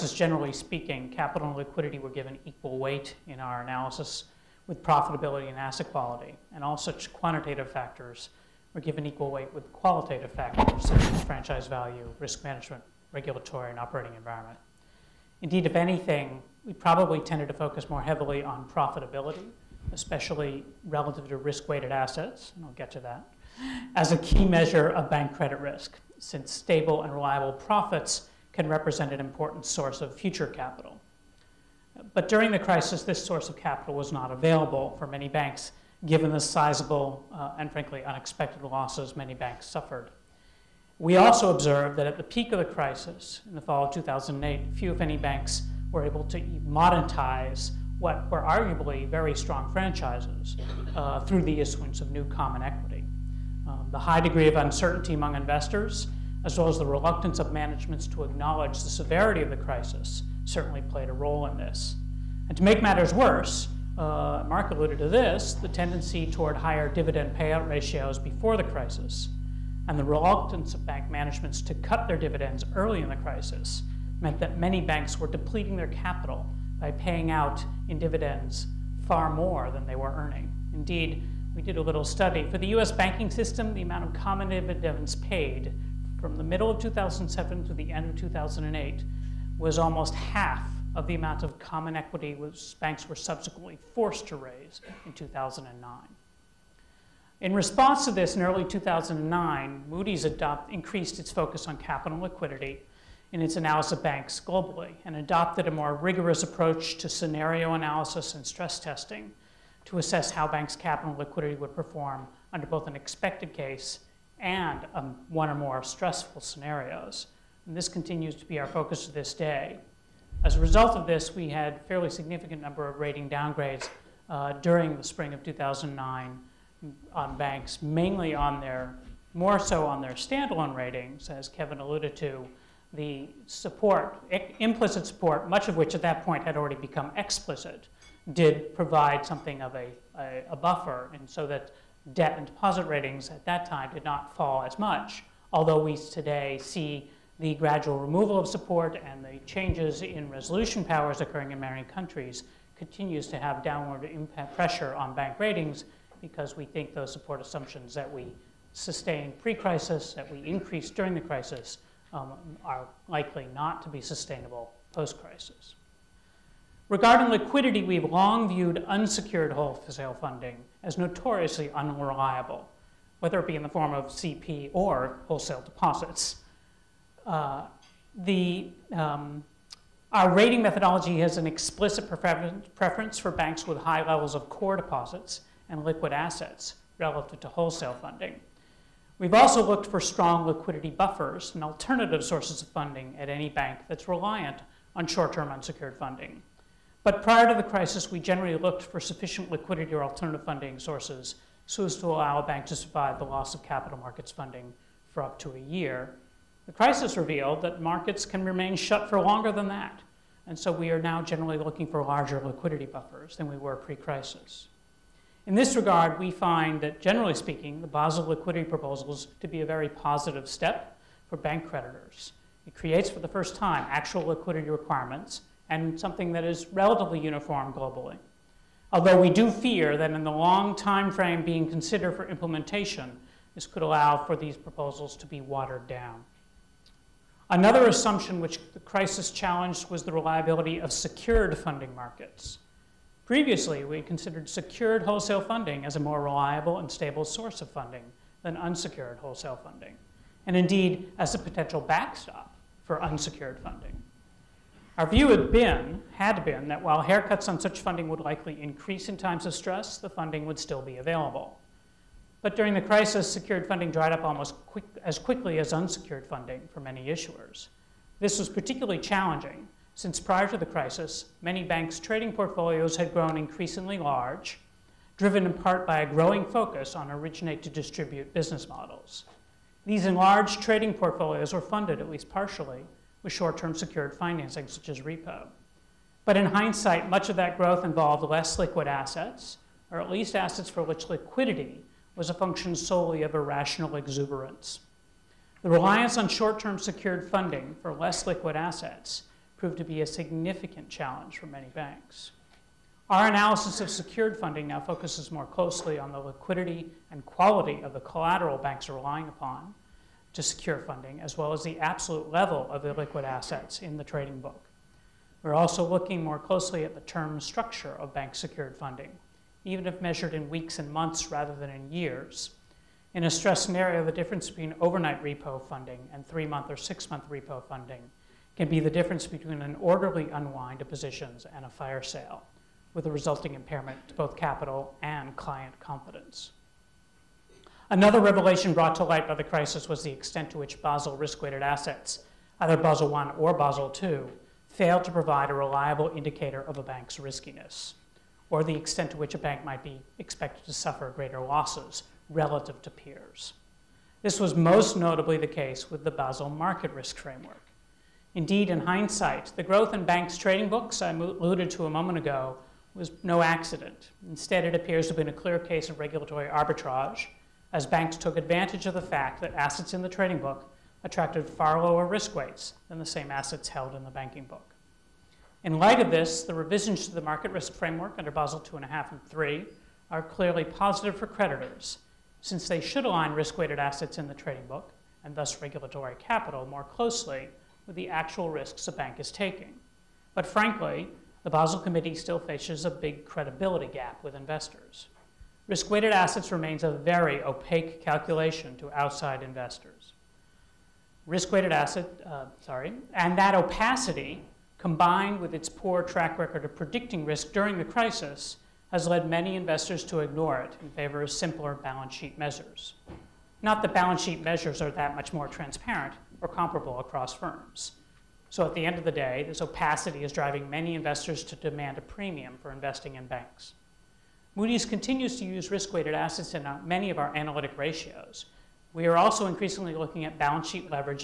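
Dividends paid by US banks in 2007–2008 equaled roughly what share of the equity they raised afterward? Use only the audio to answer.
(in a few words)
almost half.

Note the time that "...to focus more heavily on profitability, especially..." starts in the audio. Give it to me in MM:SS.
00:17.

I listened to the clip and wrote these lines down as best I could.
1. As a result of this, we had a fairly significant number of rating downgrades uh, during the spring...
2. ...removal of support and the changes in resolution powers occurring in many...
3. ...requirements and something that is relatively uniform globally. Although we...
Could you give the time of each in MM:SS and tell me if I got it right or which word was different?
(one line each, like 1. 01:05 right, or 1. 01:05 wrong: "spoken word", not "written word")
1. 02:00 right
2. 02:27 right
3. 03:44 right.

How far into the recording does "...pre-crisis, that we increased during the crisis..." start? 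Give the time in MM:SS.
02:39.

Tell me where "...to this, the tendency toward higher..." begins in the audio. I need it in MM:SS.
01:04.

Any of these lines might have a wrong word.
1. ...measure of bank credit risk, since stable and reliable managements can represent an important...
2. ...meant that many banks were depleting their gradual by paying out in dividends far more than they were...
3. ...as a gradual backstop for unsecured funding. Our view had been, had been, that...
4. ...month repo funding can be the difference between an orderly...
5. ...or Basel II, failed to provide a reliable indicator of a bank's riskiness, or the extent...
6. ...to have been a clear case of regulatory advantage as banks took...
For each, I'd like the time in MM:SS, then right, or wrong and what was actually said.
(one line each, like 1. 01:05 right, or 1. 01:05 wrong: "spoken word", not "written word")
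1. 00:24 wrong: "profits", not "managements"
2. 01:14 wrong: "capital", not "gradual"
3. 04:11 wrong: "potential", not "gradual"
4. 05:27 right
5. 05:43 right
6. 06:05 wrong: "arbitrage", not "advantage".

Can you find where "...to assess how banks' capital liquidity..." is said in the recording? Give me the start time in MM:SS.
01:49.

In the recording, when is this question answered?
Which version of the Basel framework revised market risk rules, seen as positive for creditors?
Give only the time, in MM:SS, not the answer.
06:18.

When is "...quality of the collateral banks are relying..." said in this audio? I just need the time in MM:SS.
05:07.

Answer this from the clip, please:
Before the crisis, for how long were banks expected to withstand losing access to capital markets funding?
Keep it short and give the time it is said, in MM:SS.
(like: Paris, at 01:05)
a year, at 03:25.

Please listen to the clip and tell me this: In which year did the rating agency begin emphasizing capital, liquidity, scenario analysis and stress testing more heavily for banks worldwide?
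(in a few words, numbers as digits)
2009.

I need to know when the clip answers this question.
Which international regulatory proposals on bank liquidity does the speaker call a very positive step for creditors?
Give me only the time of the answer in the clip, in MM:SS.
03:37.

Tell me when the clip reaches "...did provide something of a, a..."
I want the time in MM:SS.
02:18.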